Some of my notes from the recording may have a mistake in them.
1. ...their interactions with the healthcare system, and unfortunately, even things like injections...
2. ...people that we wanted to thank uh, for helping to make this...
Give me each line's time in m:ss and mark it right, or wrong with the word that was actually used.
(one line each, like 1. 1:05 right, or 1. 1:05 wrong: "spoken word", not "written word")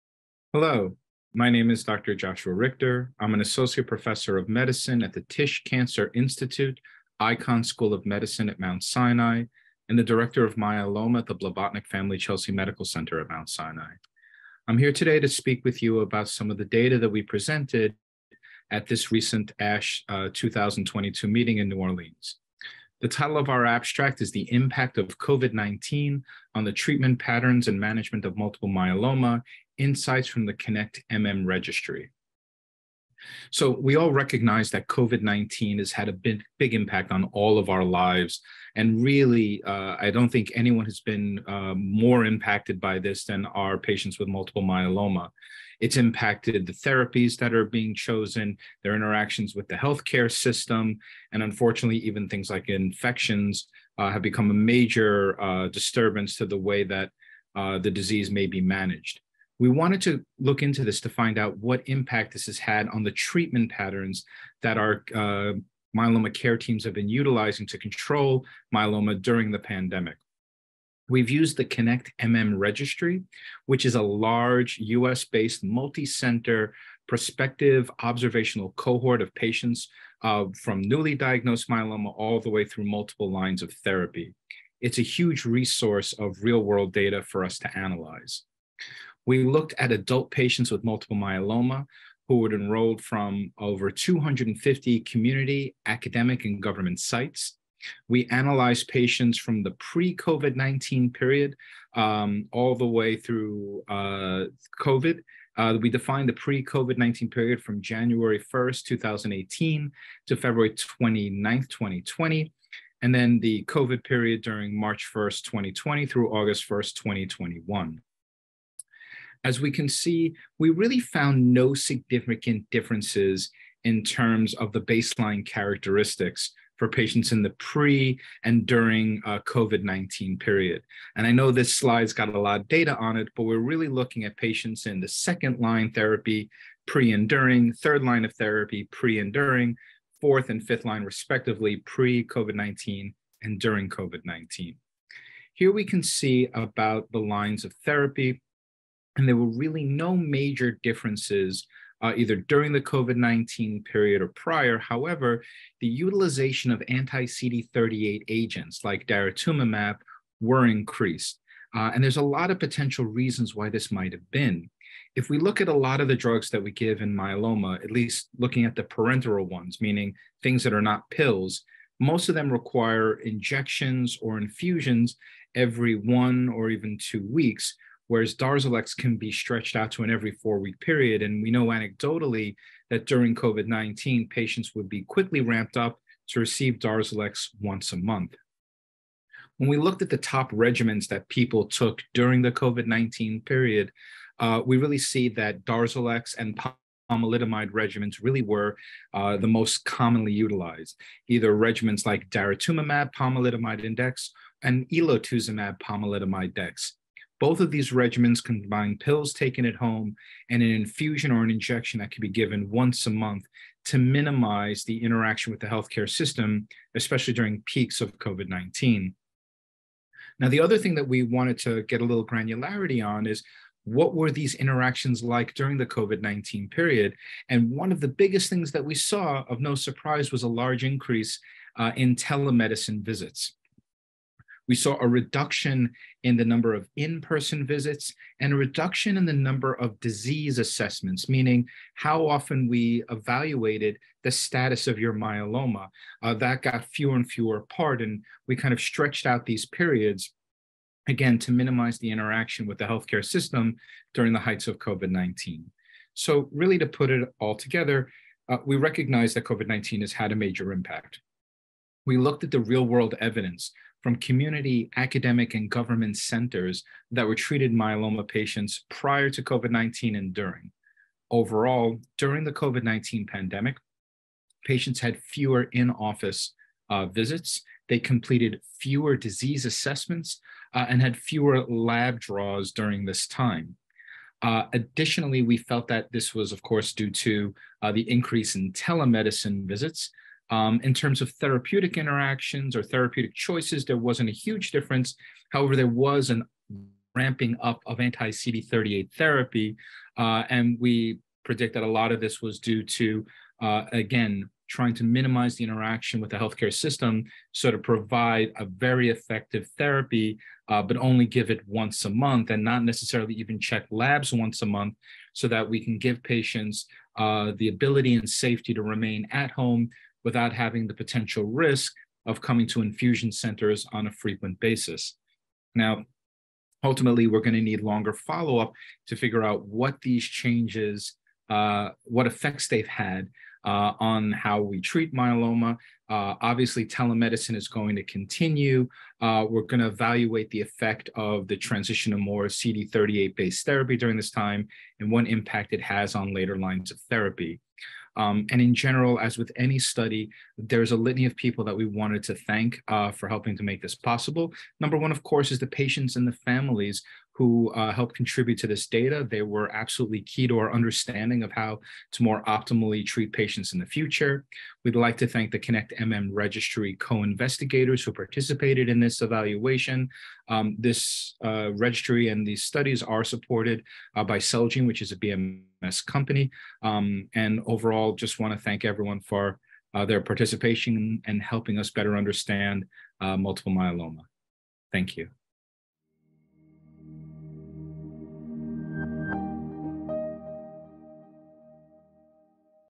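1. 0:48 wrong: "infections", not "injections"
2. 5:51 right.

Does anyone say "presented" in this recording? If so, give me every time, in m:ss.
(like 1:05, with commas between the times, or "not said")
0:17.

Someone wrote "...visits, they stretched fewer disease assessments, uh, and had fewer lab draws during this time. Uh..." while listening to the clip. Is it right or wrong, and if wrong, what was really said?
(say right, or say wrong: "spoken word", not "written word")
wrong: "completed", not "stretched".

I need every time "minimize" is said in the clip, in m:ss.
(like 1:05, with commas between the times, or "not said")
3:33, 4:11, 5:05.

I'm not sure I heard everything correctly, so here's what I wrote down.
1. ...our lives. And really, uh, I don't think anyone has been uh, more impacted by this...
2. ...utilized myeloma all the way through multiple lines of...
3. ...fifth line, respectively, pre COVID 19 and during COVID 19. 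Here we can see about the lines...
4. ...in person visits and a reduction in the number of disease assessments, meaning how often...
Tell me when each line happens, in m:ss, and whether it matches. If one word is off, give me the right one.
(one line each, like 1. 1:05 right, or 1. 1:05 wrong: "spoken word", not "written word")
1. 0:37 right
2. 1:21 wrong: "diagnosed", not "utilized"
3. 2:20 right
4. 3:56 right.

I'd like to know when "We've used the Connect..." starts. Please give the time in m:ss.
1:11.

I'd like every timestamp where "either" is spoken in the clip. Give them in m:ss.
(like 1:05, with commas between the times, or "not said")
2:32, 3:21.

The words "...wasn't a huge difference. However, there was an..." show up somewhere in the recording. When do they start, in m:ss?
4:53.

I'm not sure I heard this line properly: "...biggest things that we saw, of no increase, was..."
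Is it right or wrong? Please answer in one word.
wrong.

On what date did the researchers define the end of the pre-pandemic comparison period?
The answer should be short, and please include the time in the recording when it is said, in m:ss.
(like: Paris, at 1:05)
February 29th, 2020, at 1:50.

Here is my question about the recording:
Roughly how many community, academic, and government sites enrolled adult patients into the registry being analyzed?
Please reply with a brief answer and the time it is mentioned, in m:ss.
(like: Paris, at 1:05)
over 250, at 1:33.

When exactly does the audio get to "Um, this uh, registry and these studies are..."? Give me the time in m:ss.
6:10.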